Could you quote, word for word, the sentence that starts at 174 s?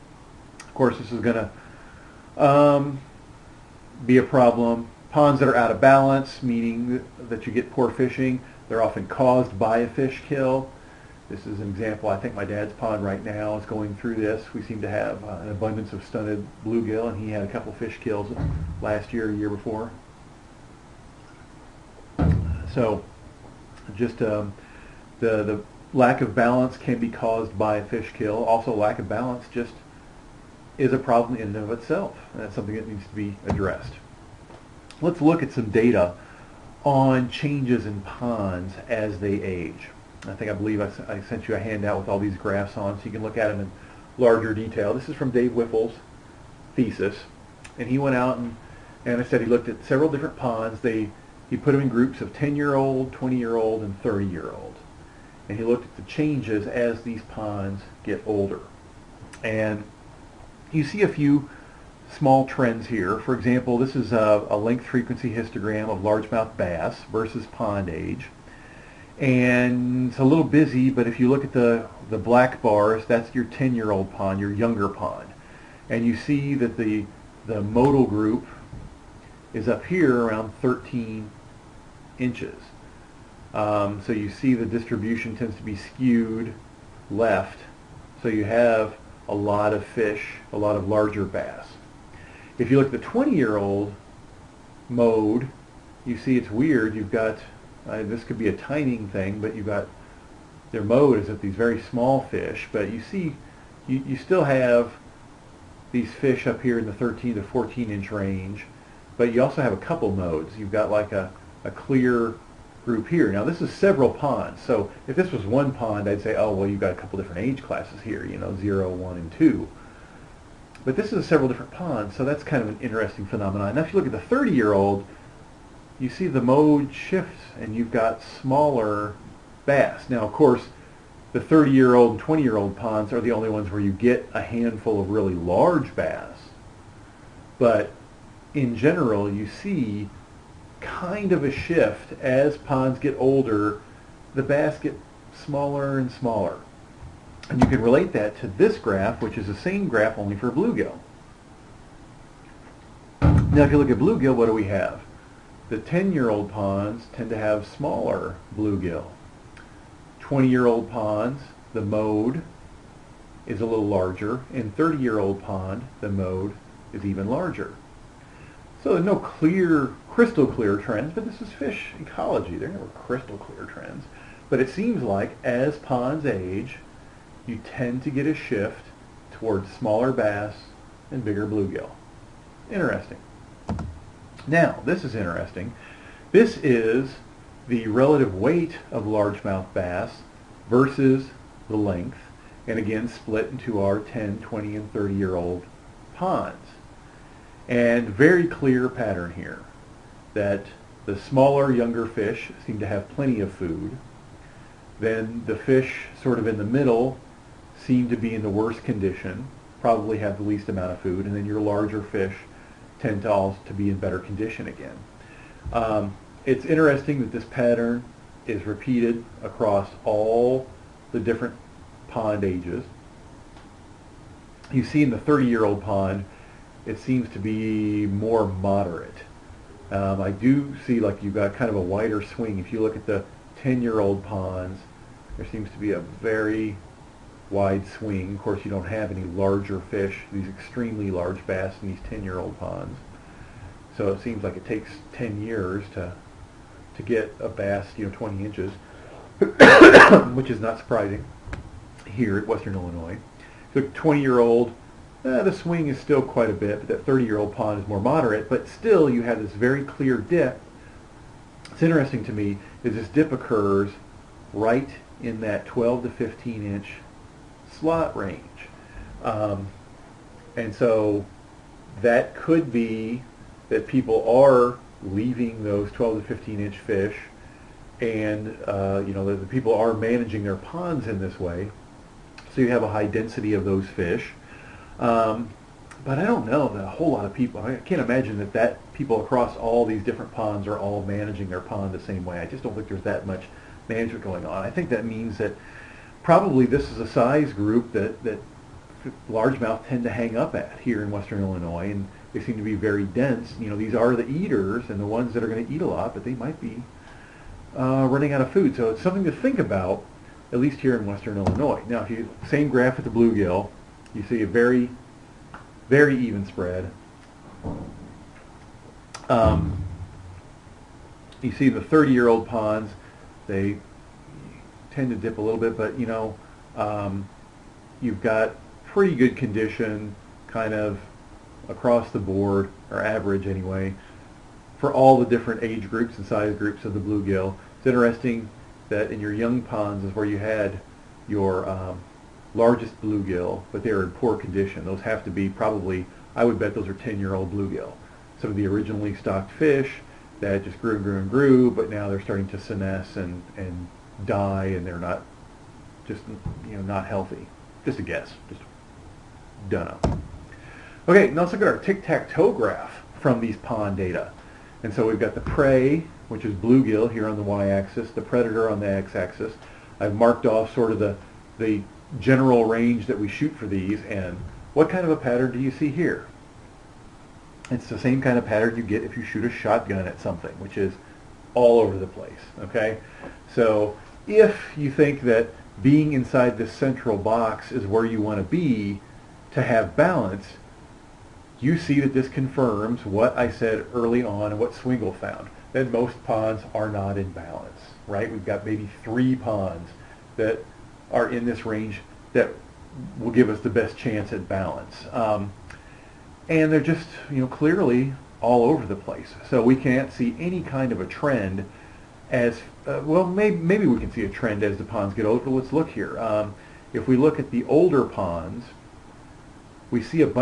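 But it seems like as ponds age, you tend to get a shift towards smaller bass and bigger bluegill.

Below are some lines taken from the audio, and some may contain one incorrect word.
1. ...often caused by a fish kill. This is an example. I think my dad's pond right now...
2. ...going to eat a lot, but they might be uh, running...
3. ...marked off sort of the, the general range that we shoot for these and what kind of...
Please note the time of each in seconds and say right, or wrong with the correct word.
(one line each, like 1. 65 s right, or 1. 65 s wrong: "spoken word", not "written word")
1. 8 s right
2. 305 s right
3. 370 s right.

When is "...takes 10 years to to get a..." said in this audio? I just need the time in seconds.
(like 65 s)
244 s.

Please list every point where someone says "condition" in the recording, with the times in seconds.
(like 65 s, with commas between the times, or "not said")
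208 s, 214 s, 329 s, 344 s.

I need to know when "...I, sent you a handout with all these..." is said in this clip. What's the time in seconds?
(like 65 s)
41 s.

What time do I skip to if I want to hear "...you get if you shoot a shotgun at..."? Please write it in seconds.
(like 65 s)
378 s.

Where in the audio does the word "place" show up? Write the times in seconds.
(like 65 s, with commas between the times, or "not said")
382 s, 408 s.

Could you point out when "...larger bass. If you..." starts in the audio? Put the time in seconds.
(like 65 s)
90 s.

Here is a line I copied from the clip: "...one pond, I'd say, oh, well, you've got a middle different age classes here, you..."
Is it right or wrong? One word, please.
wrong.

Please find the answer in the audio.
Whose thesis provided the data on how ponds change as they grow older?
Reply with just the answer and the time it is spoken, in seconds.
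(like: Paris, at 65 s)
Dave Whiffle, at 45 s.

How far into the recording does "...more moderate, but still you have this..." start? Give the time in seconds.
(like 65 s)
257 s.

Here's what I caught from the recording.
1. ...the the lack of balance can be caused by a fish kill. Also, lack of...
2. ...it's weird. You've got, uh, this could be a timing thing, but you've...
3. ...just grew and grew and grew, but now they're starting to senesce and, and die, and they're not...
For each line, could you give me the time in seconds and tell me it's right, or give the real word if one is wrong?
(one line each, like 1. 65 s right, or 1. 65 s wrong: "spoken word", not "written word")
1. 25 s right
2. 96 s right
3. 350 s right.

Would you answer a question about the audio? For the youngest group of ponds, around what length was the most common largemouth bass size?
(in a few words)
13 inches.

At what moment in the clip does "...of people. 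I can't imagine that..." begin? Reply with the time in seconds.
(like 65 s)
287 s.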